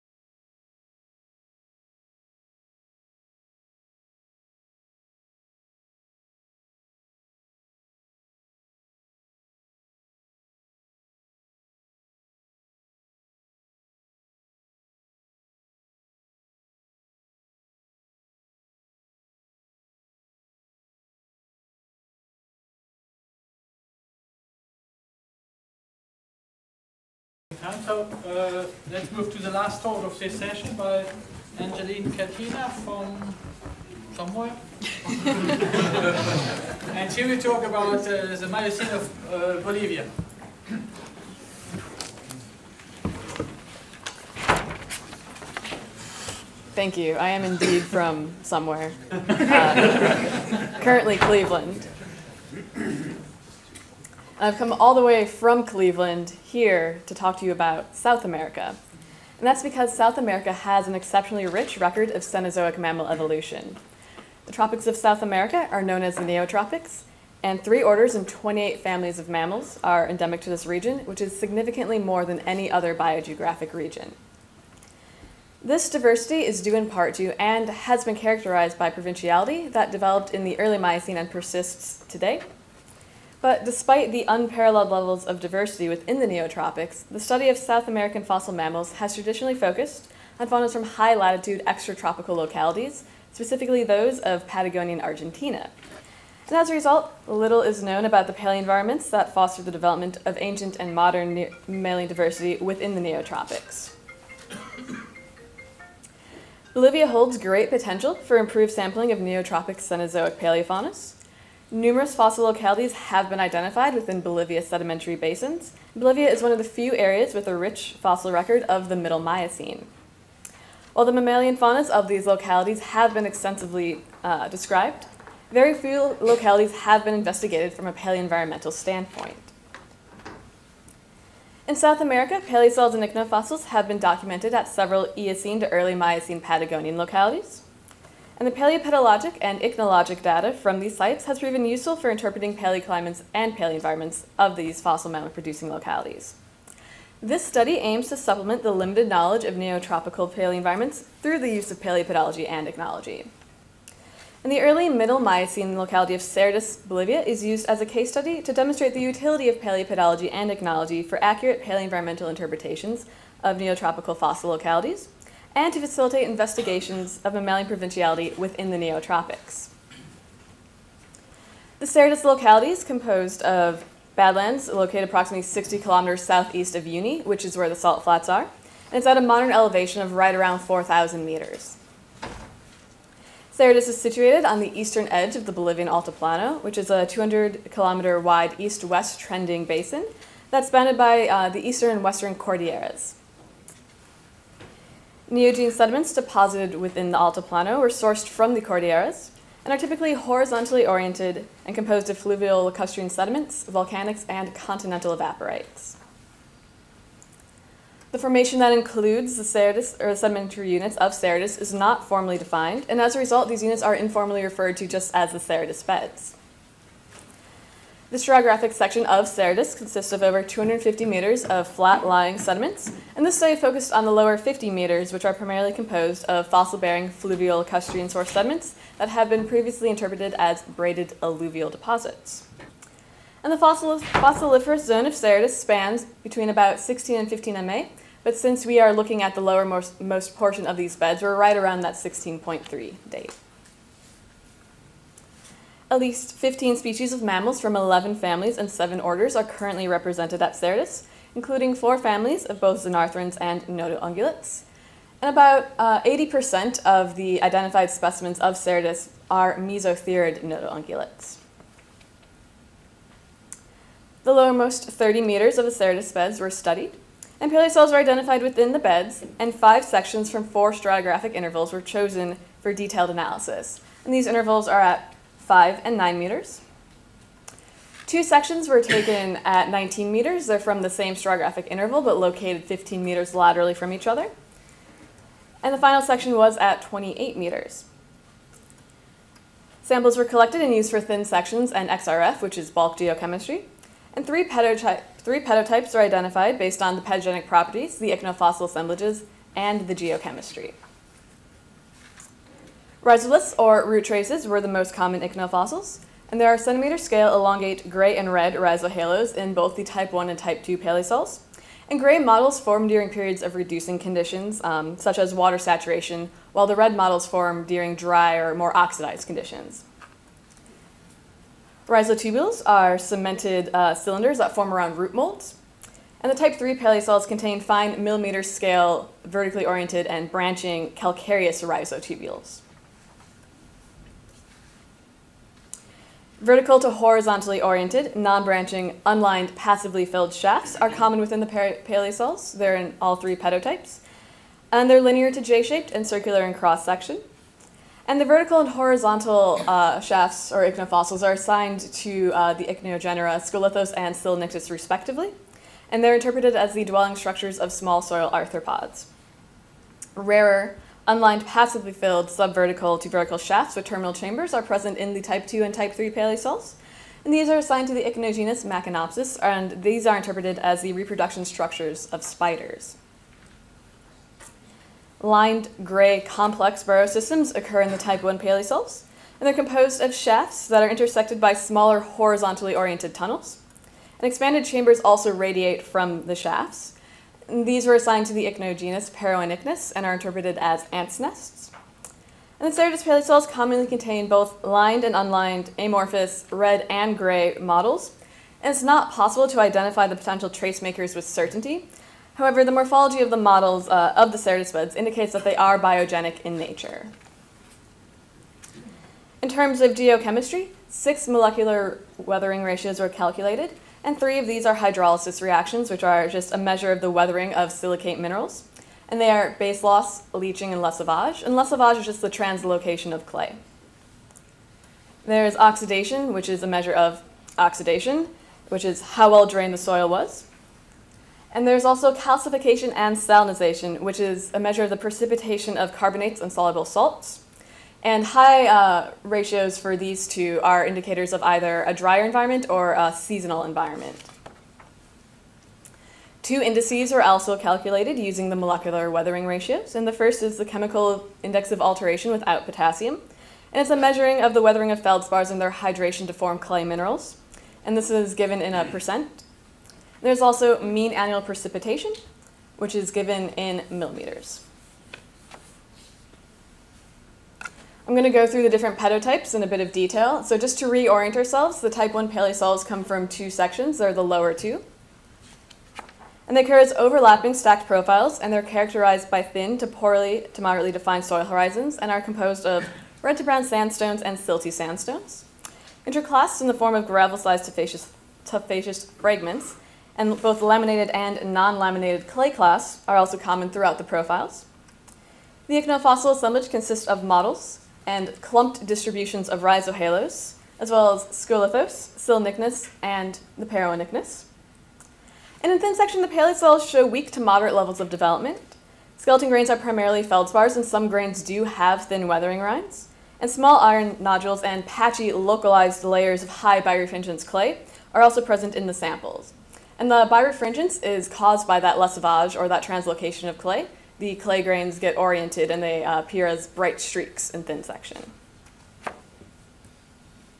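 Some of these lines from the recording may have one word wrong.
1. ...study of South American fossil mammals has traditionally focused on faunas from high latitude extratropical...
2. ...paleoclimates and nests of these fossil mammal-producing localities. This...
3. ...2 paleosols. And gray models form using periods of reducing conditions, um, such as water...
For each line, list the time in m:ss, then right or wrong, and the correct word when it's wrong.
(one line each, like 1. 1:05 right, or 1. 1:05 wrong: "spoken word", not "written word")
1. 1:27 right
2. 2:22 wrong: "paleoenvironments", not "nests"
3. 5:10 wrong: "during", not "using".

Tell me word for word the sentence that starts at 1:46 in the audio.
Bolivia holds great potential for improved sampling of neotropic Cenozoic paleofaunas.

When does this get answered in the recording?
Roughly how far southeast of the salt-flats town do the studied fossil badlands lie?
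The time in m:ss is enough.
2:55.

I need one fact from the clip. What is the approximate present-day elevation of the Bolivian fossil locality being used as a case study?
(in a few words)
4,000 meters.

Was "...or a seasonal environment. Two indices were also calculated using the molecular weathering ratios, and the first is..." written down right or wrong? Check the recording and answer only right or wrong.
right.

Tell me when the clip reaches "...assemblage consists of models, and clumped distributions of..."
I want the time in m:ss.
8:16.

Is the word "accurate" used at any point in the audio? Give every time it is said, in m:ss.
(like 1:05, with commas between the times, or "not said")
2:41.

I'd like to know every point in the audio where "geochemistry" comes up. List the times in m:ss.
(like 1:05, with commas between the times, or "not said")
4:52, 4:59, 6:49.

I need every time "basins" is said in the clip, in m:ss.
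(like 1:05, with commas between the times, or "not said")
1:55, 3:09.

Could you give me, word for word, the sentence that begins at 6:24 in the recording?
And expanded chambers also radiate from the shafts.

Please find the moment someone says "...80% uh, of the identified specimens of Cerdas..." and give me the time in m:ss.
4:15.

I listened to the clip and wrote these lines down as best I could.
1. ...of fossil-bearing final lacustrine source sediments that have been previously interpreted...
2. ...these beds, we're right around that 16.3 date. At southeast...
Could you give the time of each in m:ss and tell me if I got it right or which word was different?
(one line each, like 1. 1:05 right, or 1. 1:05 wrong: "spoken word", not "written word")
1. 3:46 wrong: "fluvial", not "final"
2. 4:00 wrong: "least", not "southeast".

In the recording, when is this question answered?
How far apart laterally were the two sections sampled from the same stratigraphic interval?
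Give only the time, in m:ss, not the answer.
4:42.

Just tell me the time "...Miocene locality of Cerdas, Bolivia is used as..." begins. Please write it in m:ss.
2:35.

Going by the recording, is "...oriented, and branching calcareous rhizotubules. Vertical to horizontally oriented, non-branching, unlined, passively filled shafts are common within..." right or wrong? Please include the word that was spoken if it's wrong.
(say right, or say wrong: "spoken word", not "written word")
right.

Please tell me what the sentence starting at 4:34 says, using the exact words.
And these intervals are at 5 and 9 meters.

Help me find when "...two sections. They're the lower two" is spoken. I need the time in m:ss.
7:53.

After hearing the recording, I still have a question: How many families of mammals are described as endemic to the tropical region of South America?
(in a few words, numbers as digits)
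28.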